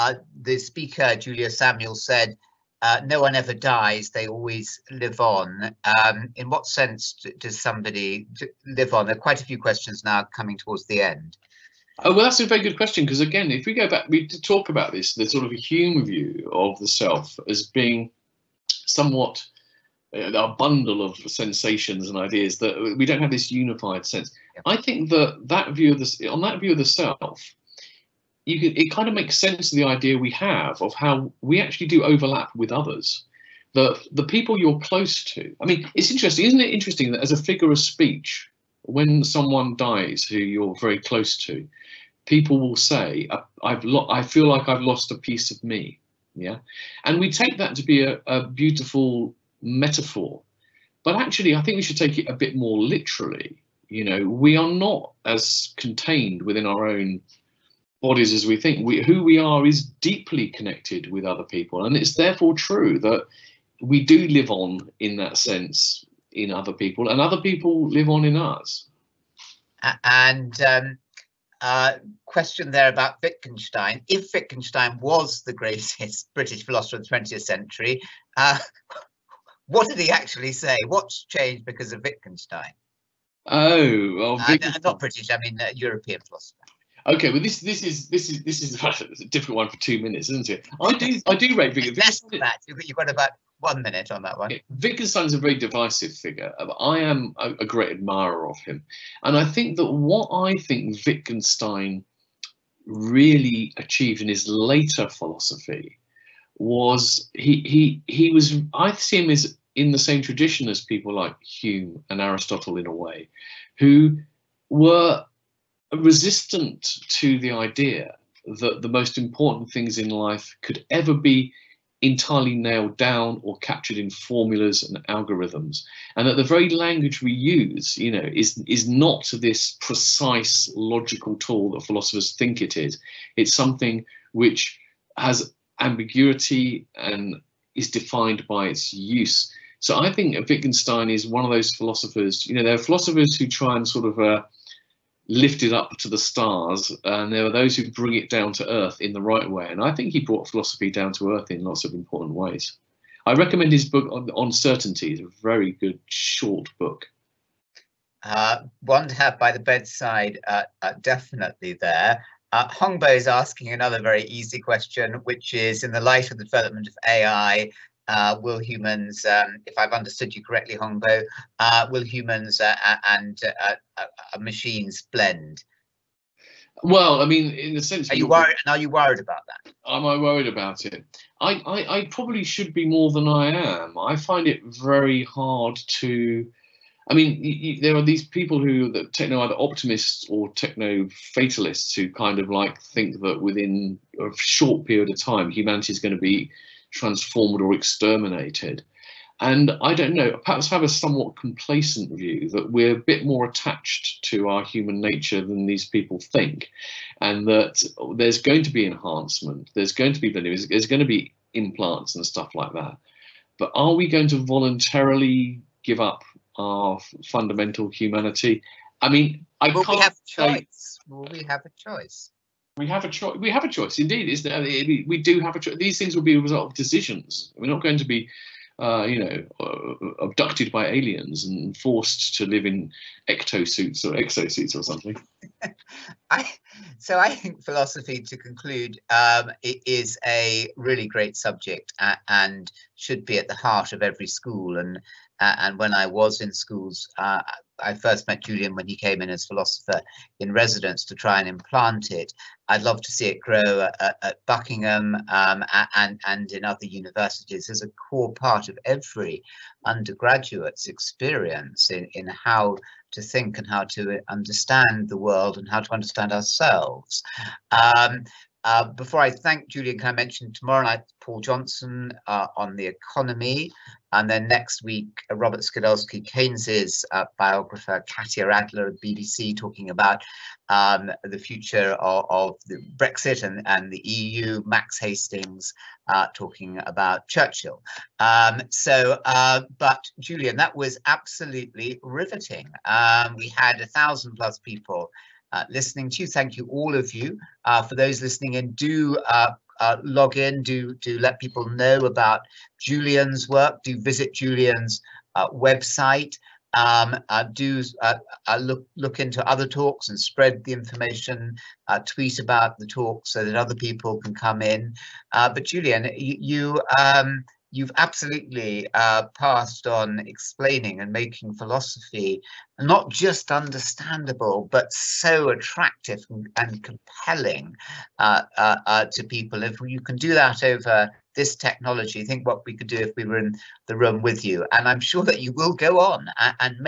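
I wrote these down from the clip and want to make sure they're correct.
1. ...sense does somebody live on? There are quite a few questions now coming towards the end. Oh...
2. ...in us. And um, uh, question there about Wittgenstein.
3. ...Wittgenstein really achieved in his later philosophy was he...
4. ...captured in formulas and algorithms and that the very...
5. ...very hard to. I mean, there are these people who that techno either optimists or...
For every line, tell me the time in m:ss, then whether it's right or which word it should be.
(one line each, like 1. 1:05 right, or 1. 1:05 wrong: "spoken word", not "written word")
1. 0:06 right
2. 1:08 right
3. 1:41 right
4. 2:03 right
5. 3:04 right.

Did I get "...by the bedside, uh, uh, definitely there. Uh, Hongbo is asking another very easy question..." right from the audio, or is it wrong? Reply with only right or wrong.
right.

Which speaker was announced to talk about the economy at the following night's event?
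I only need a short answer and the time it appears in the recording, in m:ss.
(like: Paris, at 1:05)
Paul Johnson, at 4:31.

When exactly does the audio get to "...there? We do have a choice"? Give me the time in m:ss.
3:44.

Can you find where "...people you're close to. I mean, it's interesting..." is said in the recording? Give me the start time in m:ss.
0:34.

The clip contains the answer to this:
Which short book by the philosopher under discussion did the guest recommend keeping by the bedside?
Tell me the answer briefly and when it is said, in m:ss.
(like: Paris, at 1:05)
On Certainty, at 2:34.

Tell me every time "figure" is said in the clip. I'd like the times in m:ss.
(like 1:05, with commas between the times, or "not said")
0:37, 1:36.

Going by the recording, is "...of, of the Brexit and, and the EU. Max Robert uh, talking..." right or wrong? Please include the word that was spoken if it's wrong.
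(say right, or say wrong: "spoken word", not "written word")
wrong: "Hastings", not "Robert".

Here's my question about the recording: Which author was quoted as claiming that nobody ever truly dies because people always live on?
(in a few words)
Julia Samuel.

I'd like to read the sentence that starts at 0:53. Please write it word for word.
You know, we are not as contained within our own bodies as we think.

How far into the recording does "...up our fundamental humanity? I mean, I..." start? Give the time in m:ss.
3:36.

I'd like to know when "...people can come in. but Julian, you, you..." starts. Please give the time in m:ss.
5:13.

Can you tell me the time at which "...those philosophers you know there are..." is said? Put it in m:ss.
2:21.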